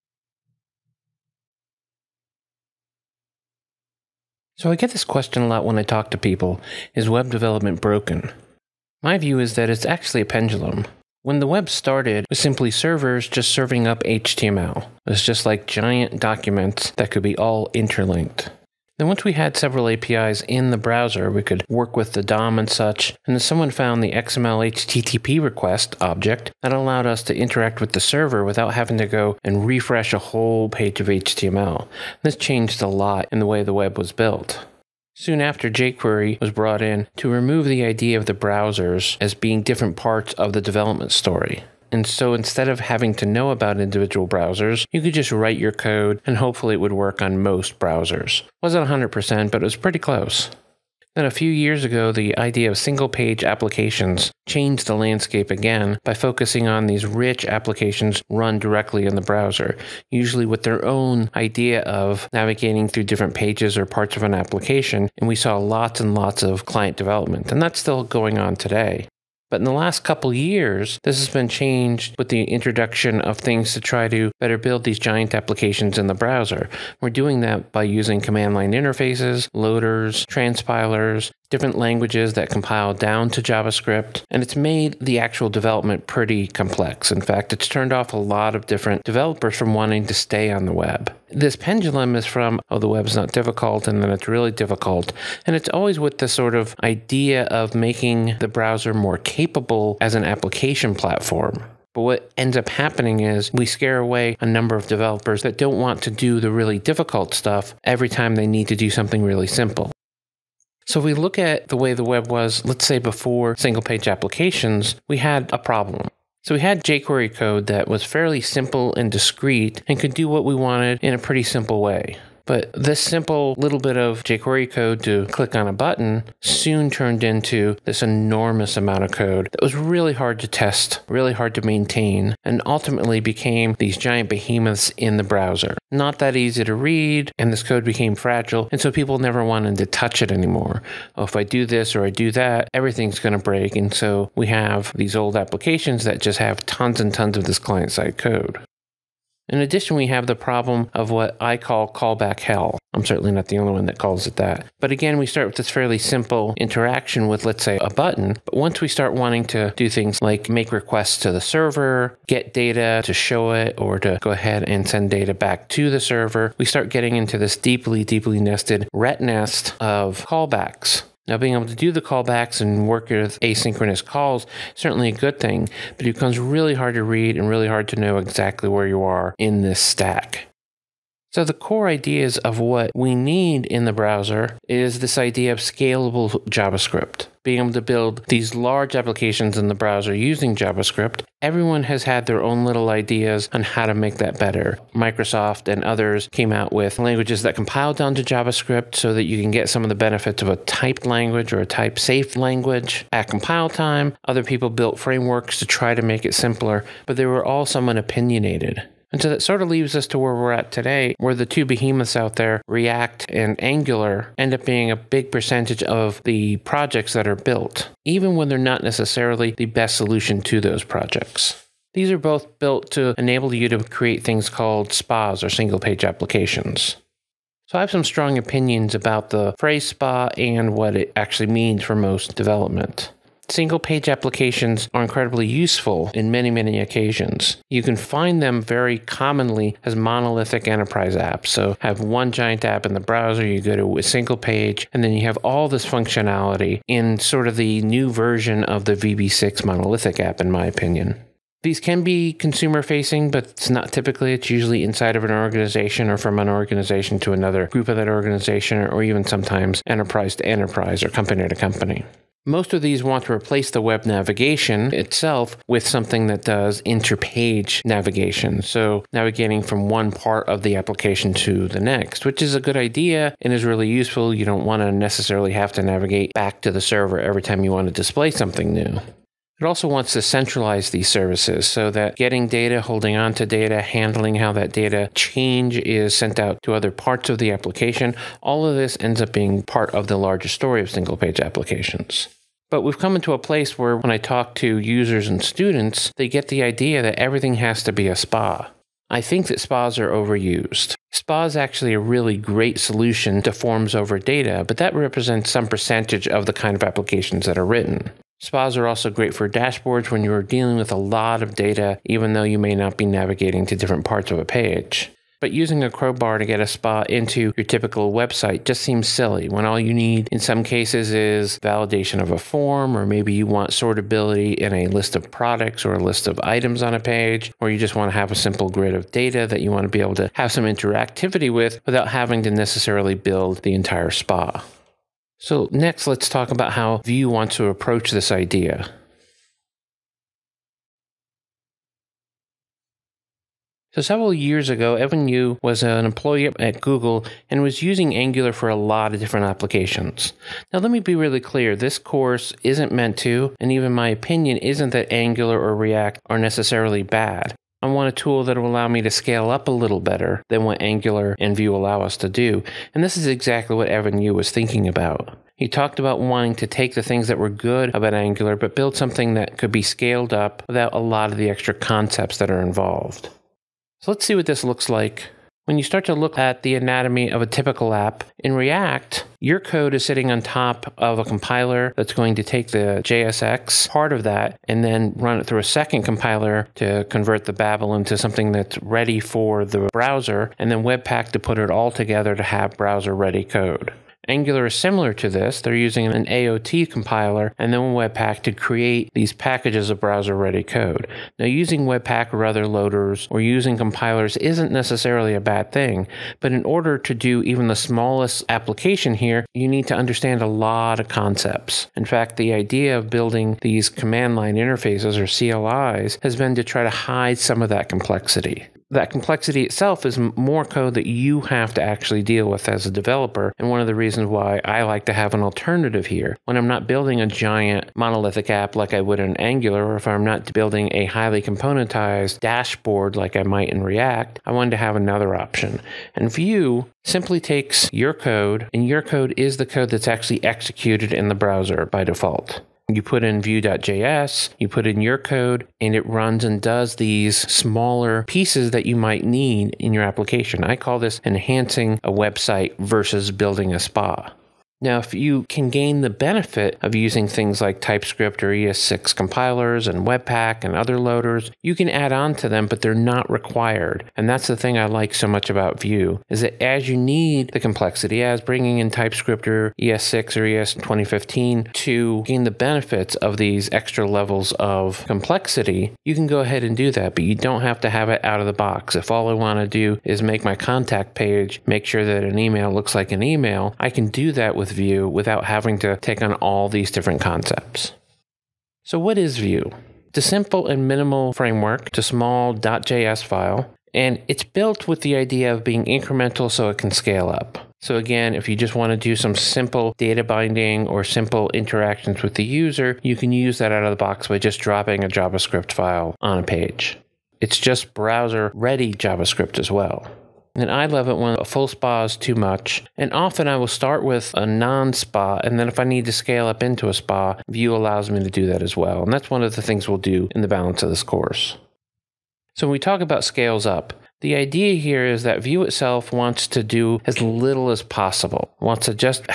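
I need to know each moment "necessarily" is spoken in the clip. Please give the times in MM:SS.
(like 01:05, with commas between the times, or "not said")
03:38, 04:34, 05:32, 05:56, 06:44.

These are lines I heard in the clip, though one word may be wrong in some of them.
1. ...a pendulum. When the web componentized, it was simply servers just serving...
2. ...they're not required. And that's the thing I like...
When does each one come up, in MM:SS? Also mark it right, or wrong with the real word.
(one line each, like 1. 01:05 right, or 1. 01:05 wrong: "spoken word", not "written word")
1. 00:10 wrong: "started", not "componentized"
2. 07:42 right.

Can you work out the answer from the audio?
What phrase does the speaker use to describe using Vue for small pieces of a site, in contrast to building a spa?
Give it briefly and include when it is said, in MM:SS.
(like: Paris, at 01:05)
enhancing a website, at 07:31.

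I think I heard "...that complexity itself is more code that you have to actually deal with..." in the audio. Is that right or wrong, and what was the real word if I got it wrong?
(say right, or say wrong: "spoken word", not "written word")
right.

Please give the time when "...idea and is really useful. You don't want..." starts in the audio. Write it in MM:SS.
04:32.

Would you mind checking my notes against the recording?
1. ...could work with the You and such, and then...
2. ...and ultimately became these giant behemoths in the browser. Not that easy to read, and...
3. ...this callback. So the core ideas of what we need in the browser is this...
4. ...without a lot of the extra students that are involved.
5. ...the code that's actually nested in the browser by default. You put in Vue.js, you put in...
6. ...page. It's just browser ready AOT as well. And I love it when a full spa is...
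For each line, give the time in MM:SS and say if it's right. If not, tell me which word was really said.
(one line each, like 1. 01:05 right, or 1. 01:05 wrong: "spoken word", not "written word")
1. 00:21 wrong: "DOM", not "You"
2. 02:12 right
3. 02:59 wrong: "stack", not "callback"
4. 06:10 wrong: "concepts", not "students"
5. 07:19 wrong: "executed", not "nested"
6. 08:26 wrong: "JavaScript", not "AOT".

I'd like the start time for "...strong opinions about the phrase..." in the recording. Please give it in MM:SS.
03:48.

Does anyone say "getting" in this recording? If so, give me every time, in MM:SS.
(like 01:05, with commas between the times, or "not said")
02:46, 04:42.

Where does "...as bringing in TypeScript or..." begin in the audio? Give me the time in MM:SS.
07:48.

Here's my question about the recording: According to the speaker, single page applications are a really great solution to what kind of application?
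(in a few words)
forms over data.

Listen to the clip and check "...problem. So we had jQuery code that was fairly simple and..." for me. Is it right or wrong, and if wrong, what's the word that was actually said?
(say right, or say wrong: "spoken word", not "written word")
right.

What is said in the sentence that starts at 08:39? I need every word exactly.
And that's one of the things we'll do in the balance of this course.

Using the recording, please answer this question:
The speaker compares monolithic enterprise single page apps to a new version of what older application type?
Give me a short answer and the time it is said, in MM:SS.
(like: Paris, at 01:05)
VB6 monolithic app, at 04:08.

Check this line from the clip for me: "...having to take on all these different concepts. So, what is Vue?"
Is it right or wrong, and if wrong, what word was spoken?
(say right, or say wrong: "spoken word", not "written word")
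right.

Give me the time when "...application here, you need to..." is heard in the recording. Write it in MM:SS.
06:48.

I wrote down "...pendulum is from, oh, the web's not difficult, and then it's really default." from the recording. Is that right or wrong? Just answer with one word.
wrong.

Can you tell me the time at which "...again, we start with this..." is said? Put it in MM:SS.
02:34.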